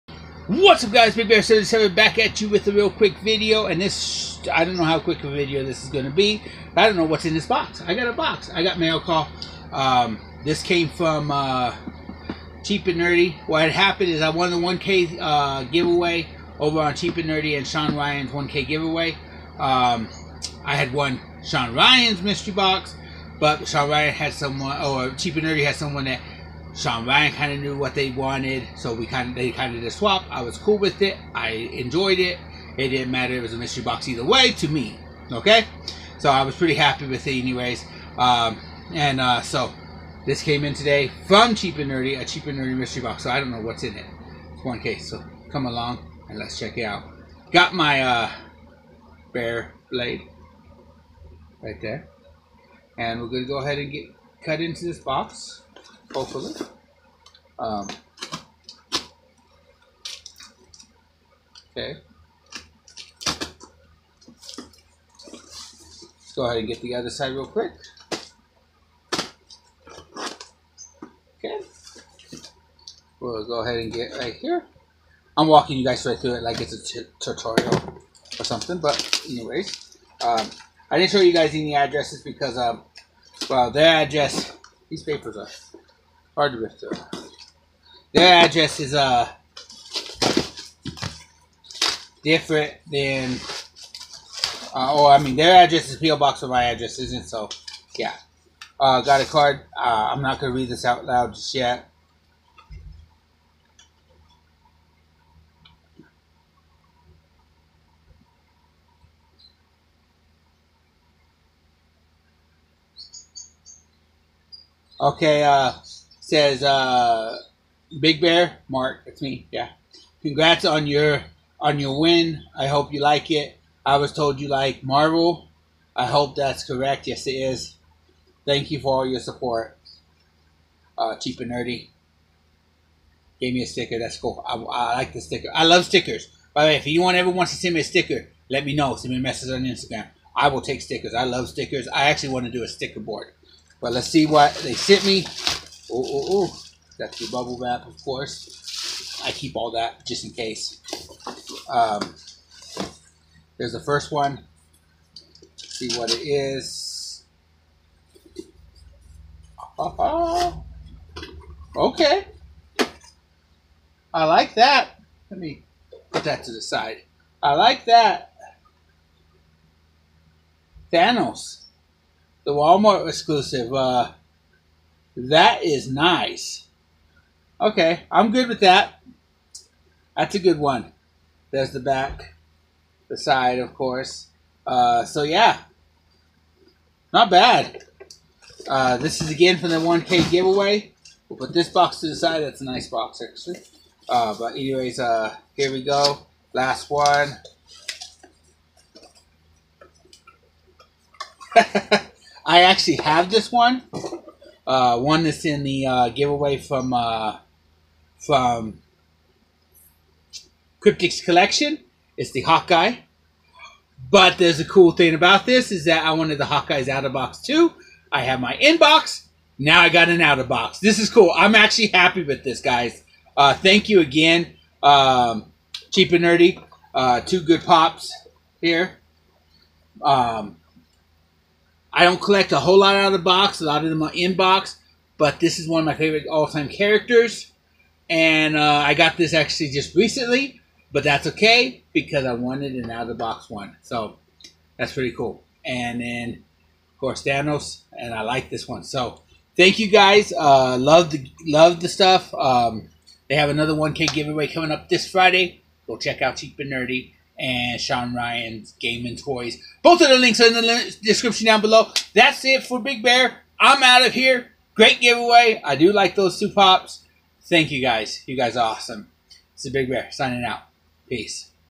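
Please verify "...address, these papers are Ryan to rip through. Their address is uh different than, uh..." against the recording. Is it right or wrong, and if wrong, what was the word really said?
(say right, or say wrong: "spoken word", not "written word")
wrong: "Hard", not "Ryan".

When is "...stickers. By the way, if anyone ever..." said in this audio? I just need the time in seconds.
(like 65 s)
135 s.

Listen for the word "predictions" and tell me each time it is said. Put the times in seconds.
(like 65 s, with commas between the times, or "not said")
not said.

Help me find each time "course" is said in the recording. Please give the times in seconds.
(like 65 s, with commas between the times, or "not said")
148 s, 183 s, 246 s.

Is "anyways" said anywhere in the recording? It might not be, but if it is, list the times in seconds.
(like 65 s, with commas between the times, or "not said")
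37 s, 79 s, 194 s.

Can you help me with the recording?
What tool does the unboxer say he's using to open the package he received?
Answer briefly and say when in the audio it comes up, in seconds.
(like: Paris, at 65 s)
bear blade, at 49 s.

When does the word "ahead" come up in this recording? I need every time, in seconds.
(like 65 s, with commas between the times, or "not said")
53 s, 66 s, 73 s.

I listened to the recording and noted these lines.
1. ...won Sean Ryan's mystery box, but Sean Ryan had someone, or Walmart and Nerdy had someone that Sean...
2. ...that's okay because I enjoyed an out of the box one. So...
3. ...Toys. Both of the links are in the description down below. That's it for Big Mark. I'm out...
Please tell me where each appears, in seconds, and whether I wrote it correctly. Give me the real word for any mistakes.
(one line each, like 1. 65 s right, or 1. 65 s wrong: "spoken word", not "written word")
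1. 20 s wrong: "Cheap", not "Walmart"
2. 241 s wrong: "wanted", not "enjoyed"
3. 259 s wrong: "Bear", not "Mark".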